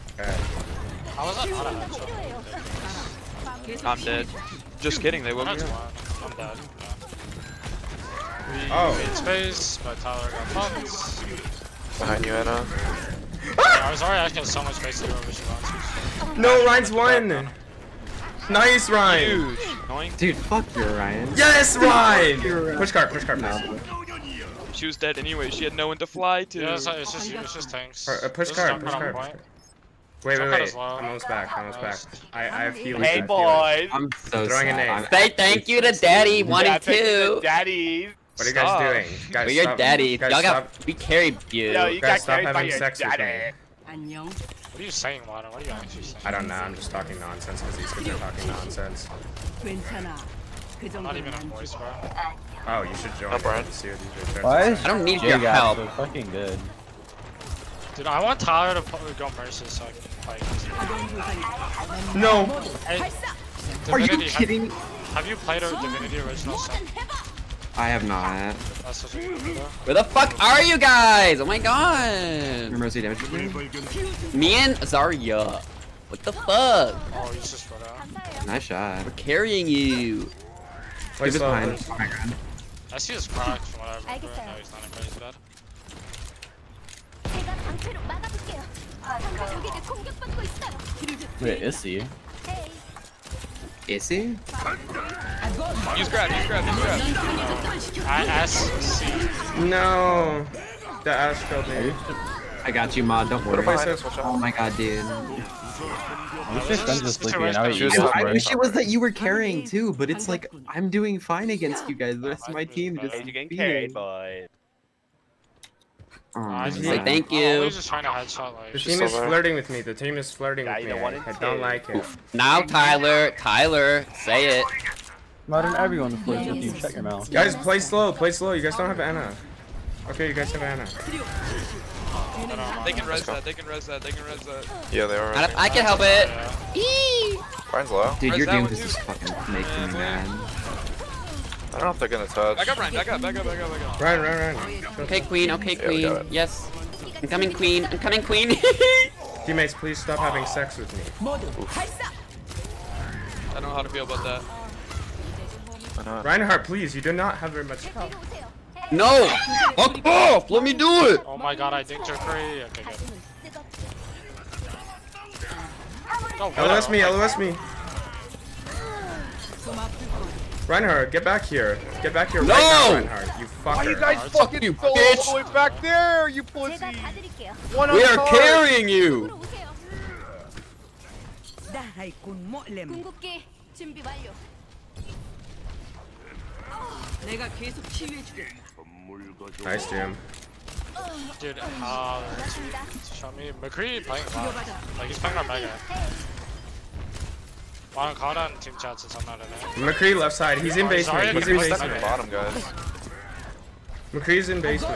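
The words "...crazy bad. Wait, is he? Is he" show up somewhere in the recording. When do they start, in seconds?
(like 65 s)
90 s.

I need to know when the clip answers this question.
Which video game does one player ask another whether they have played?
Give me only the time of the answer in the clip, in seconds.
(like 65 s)
65 s.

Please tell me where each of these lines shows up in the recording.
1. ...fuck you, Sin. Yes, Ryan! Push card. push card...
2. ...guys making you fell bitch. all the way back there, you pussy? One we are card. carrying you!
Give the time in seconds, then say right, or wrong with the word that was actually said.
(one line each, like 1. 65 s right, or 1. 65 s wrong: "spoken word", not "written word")
1. 20 s wrong: "Ryan", not "Sin"
2. 173 s wrong: "fucking", not "making".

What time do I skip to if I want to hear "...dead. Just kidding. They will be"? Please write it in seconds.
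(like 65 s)
4 s.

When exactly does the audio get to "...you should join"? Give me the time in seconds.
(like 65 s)
52 s.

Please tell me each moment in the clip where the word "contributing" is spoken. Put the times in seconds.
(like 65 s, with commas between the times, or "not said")
not said.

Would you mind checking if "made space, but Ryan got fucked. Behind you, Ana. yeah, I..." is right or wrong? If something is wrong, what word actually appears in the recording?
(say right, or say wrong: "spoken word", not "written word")
wrong: "Tyler", not "Ryan".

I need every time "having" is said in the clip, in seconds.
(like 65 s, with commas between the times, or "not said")
42 s, 150 s.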